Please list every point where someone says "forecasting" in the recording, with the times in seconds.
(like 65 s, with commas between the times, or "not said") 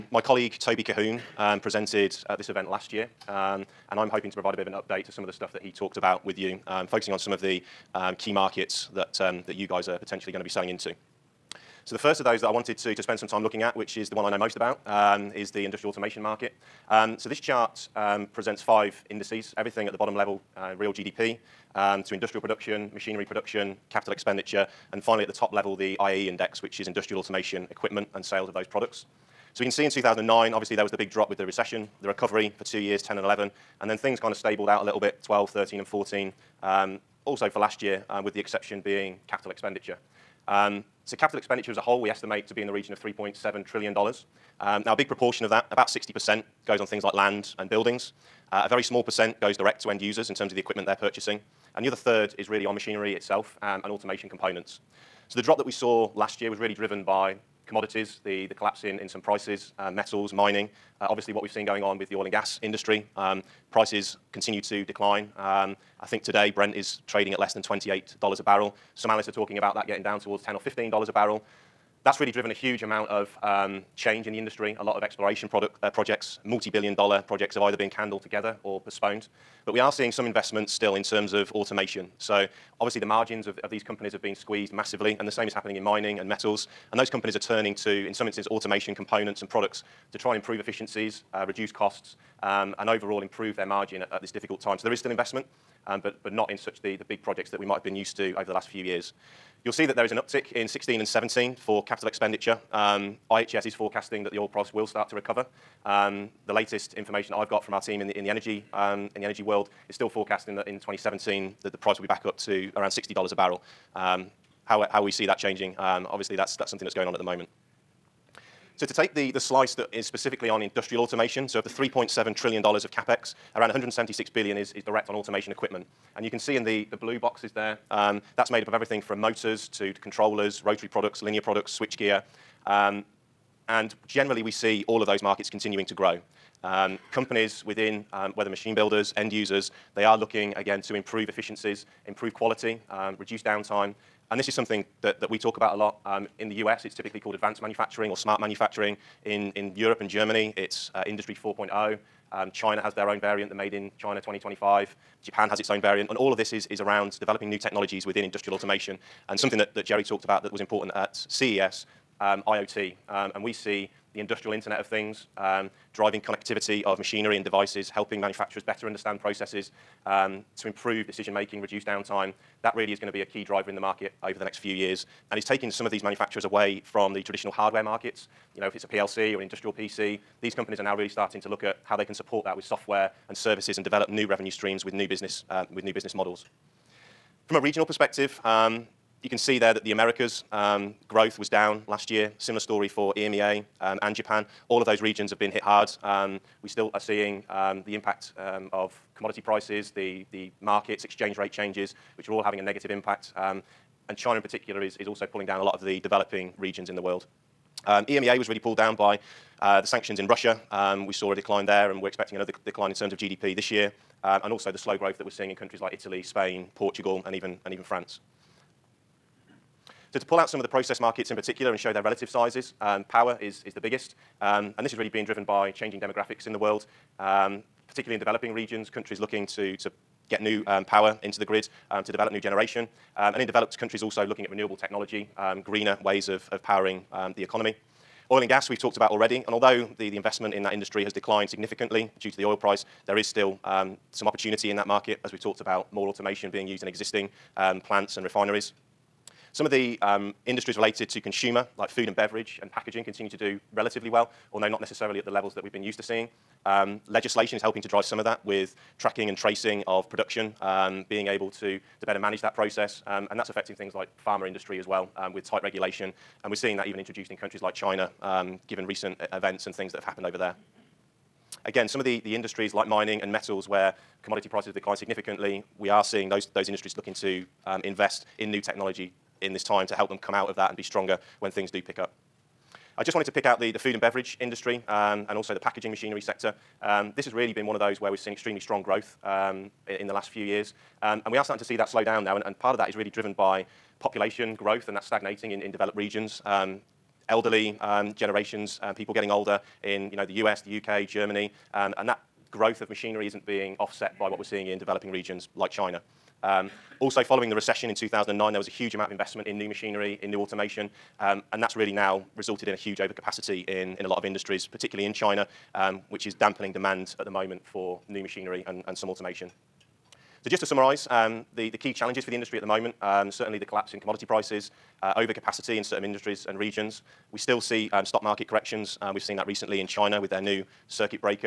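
103 s, 110 s.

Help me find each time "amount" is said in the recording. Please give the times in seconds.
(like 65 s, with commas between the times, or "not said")
72 s, 308 s.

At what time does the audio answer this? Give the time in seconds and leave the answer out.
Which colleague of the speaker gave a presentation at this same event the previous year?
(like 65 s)
0 s.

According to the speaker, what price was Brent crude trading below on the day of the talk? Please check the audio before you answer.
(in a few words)
$28 a barrel.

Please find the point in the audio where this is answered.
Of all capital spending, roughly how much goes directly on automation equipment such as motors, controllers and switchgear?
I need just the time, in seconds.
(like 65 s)
123 s.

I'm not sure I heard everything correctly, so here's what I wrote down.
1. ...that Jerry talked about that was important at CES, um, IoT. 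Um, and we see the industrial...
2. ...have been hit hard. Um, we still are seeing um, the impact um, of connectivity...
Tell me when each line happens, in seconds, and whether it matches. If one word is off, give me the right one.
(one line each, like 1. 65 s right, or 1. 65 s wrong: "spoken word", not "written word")
1. 159 s right
2. 195 s wrong: "commodity", not "connectivity".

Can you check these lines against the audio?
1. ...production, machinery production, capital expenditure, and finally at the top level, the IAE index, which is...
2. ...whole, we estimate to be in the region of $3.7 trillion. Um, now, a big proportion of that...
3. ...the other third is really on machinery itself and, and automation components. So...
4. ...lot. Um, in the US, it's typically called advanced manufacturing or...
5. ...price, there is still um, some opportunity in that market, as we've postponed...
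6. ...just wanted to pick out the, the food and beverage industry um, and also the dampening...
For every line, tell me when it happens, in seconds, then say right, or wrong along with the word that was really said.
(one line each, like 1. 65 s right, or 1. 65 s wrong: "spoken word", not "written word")
1. 22 s right
2. 41 s right
3. 51 s right
4. 145 s right
5. 242 s wrong: "talked", not "postponed"
6. 283 s wrong: "packaging", not "dampening".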